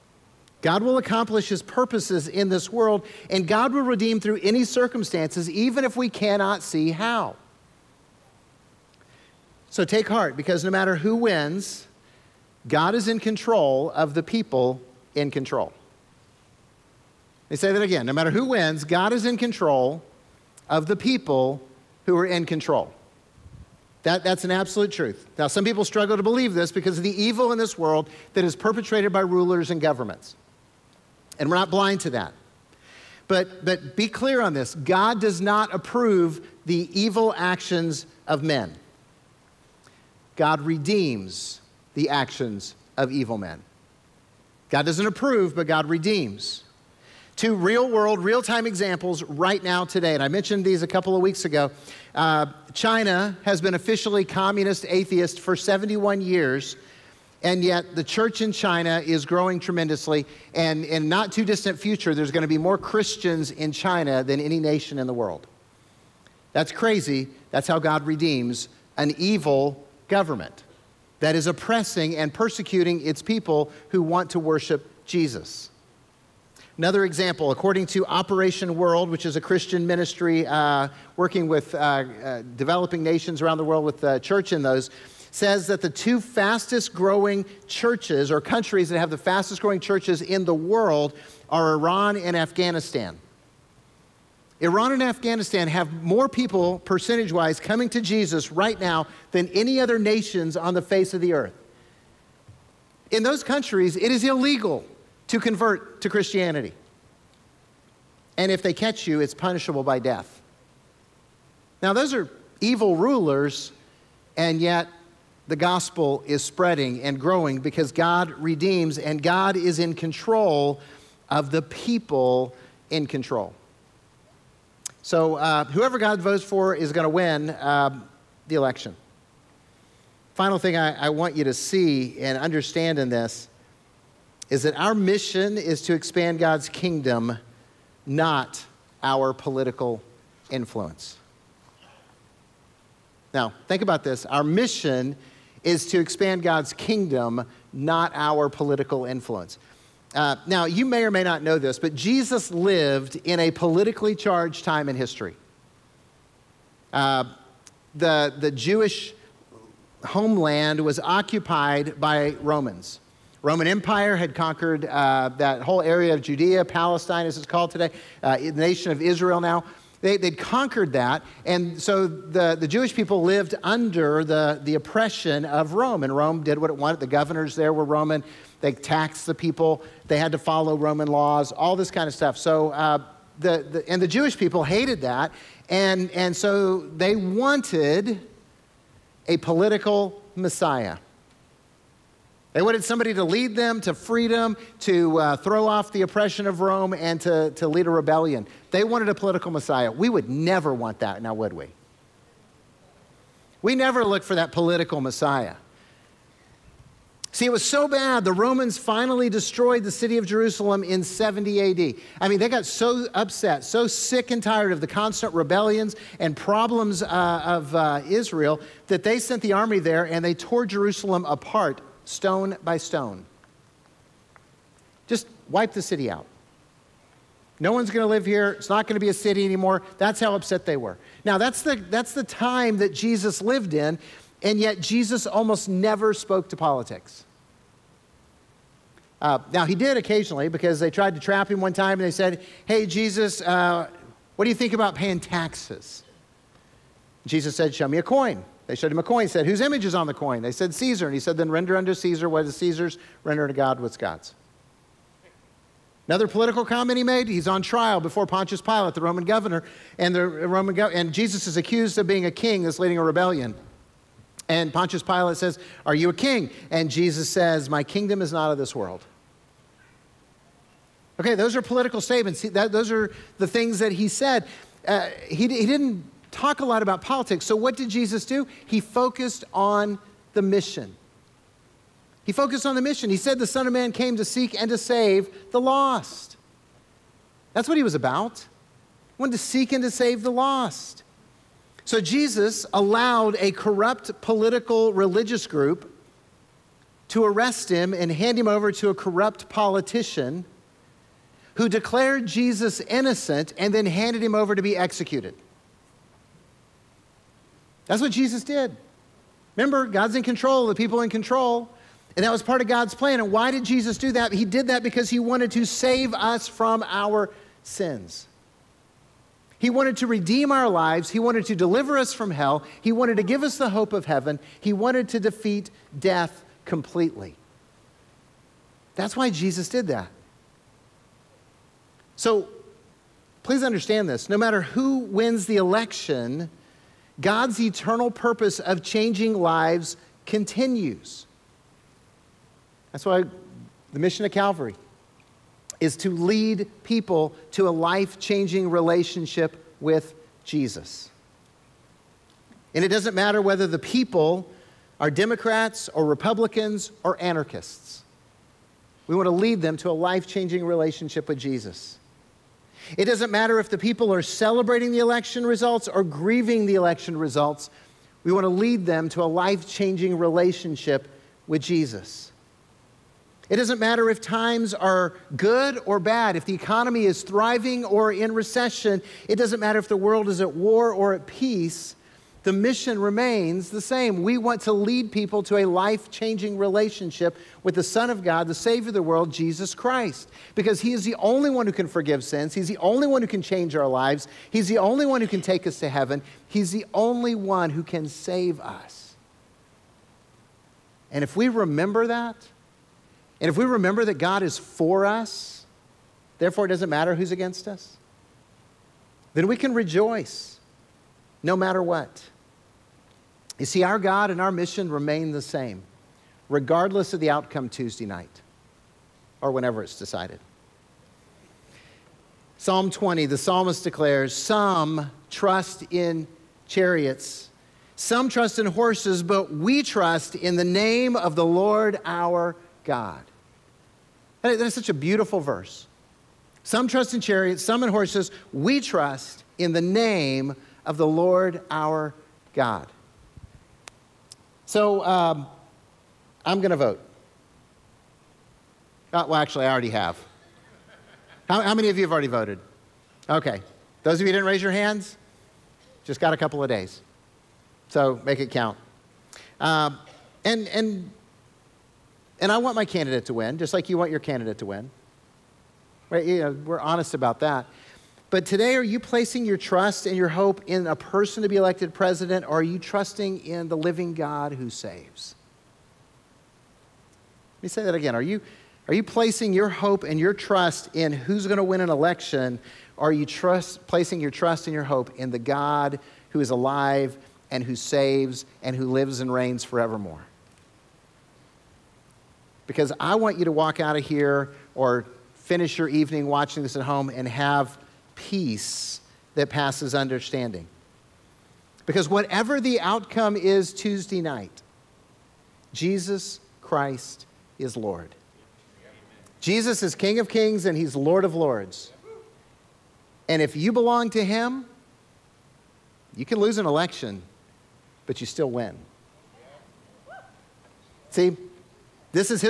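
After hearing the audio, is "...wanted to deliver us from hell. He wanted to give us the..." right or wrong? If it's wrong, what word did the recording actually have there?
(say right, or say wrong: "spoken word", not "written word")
right.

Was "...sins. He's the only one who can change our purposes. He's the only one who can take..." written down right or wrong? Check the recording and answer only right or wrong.
wrong.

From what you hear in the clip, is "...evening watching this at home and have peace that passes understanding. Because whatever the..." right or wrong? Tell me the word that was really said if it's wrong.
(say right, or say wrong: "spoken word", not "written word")
right.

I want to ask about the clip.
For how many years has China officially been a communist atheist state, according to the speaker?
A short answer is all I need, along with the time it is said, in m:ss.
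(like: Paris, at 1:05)
71, at 0:55.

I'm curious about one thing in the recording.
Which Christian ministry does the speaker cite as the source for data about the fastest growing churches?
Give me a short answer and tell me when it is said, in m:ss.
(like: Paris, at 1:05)
Operation World, at 1:18.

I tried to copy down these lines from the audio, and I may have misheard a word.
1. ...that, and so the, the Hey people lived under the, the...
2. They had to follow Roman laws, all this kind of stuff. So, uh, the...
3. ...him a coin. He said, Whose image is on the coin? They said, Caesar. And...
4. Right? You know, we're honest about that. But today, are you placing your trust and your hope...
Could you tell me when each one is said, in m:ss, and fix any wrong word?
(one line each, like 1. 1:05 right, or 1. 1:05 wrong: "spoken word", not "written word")
1. 2:50 wrong: "Jewish", not "Hey"
2. 3:00 right
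3. 4:08 right
4. 7:46 right.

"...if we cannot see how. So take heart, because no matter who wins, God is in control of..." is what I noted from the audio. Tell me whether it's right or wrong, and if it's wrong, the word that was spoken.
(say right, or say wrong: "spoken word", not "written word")
right.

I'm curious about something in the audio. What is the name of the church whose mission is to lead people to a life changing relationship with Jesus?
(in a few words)
Calvary.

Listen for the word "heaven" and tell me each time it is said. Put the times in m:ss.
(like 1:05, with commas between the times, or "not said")
5:24, 6:35.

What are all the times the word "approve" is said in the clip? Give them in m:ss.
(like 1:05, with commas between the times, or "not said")
0:35, 0:45.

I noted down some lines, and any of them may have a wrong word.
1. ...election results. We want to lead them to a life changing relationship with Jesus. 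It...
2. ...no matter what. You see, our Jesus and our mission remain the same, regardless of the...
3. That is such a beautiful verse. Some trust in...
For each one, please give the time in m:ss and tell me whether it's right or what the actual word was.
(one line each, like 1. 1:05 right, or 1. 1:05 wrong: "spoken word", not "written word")
1. 6:06 right
2. 6:51 wrong: "God", not "Jesus"
3. 7:14 right.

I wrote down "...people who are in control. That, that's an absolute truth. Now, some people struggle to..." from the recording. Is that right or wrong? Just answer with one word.
right.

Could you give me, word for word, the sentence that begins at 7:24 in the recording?
So um, I'm going to vote.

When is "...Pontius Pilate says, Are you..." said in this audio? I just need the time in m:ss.
4:24.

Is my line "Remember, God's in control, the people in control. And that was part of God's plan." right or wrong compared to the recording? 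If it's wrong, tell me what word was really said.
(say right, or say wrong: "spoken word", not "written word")
right.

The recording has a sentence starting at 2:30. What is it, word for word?
Uh, now, you may or may not know this, but Jesus lived in a politically charged time in history.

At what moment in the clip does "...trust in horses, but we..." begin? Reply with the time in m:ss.
7:08.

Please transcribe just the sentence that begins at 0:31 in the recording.
And we're not blind to that.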